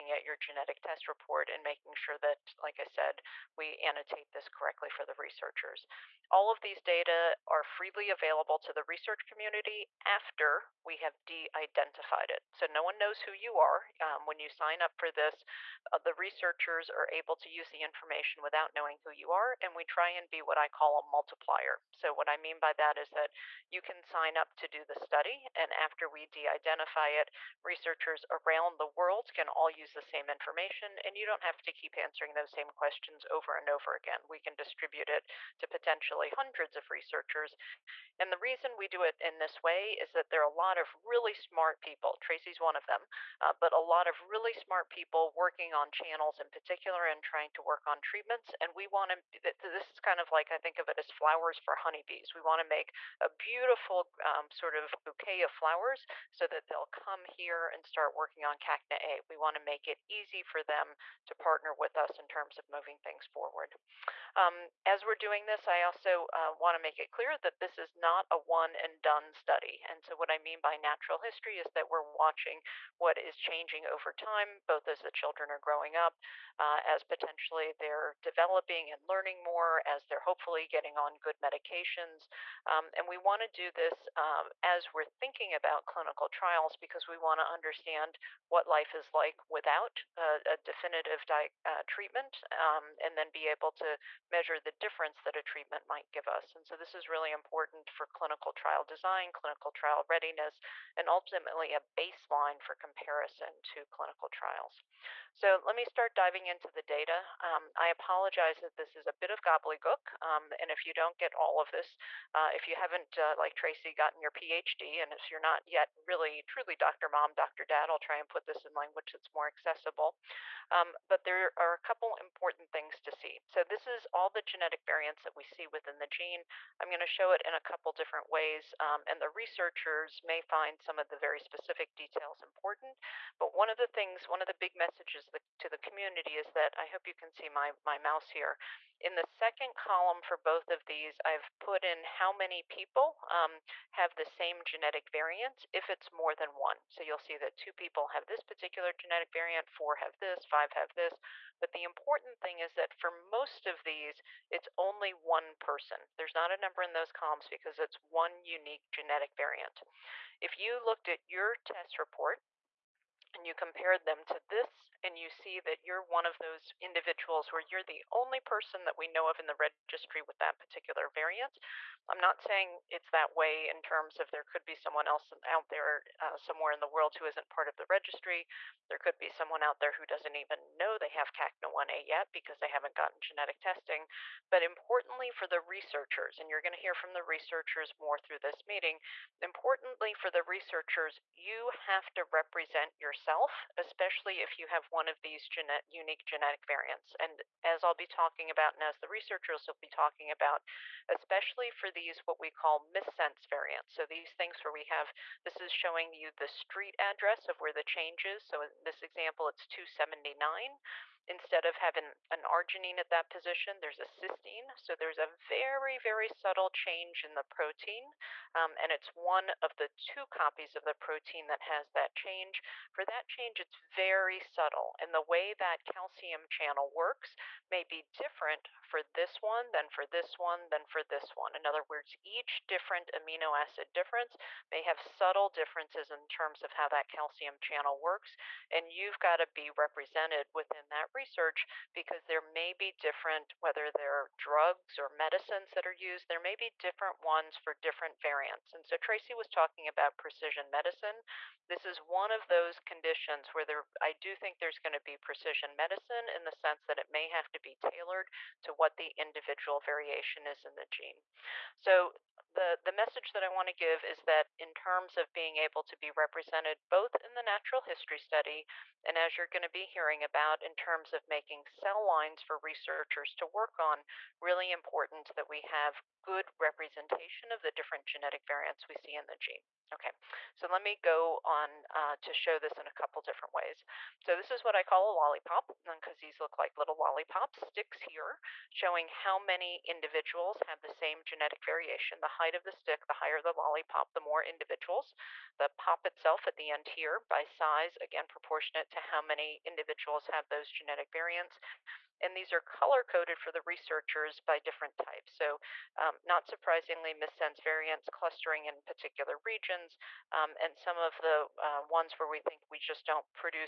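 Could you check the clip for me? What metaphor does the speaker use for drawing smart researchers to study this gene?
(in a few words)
flowers for honeybees.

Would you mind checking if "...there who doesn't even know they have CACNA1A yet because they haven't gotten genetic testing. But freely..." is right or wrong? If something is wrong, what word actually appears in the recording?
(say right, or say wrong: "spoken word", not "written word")
wrong: "importantly", not "freely".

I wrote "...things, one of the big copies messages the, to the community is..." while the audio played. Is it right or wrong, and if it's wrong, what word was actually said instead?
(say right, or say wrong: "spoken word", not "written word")
wrong: "messages", not "copies".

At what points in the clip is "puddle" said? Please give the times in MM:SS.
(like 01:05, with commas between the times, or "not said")
not said.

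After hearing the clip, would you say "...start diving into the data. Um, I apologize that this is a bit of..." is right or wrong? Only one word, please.
right.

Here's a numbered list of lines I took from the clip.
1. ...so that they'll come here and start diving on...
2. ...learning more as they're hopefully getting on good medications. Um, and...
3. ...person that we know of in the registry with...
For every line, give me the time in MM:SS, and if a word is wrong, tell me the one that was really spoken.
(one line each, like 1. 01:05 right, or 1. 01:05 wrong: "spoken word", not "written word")
1. 00:56 wrong: "working", not "diving"
2. 01:19 right
3. 02:48 right.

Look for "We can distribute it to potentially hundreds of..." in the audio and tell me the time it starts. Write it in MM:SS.
00:34.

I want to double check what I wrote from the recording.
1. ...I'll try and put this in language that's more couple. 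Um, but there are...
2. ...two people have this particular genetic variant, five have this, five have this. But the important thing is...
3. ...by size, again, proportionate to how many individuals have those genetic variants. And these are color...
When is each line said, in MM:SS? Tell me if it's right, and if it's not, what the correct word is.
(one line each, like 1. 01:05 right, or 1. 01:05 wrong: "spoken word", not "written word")
1. 01:57 wrong: "accessible", not "couple"
2. 02:27 wrong: "four", not "five"
3. 04:57 right.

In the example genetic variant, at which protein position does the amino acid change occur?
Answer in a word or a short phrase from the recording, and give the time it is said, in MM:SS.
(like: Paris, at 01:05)
279, at 03:29.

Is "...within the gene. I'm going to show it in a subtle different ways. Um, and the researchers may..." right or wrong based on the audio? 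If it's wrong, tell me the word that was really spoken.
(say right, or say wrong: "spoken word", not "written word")
wrong: "couple", not "subtle".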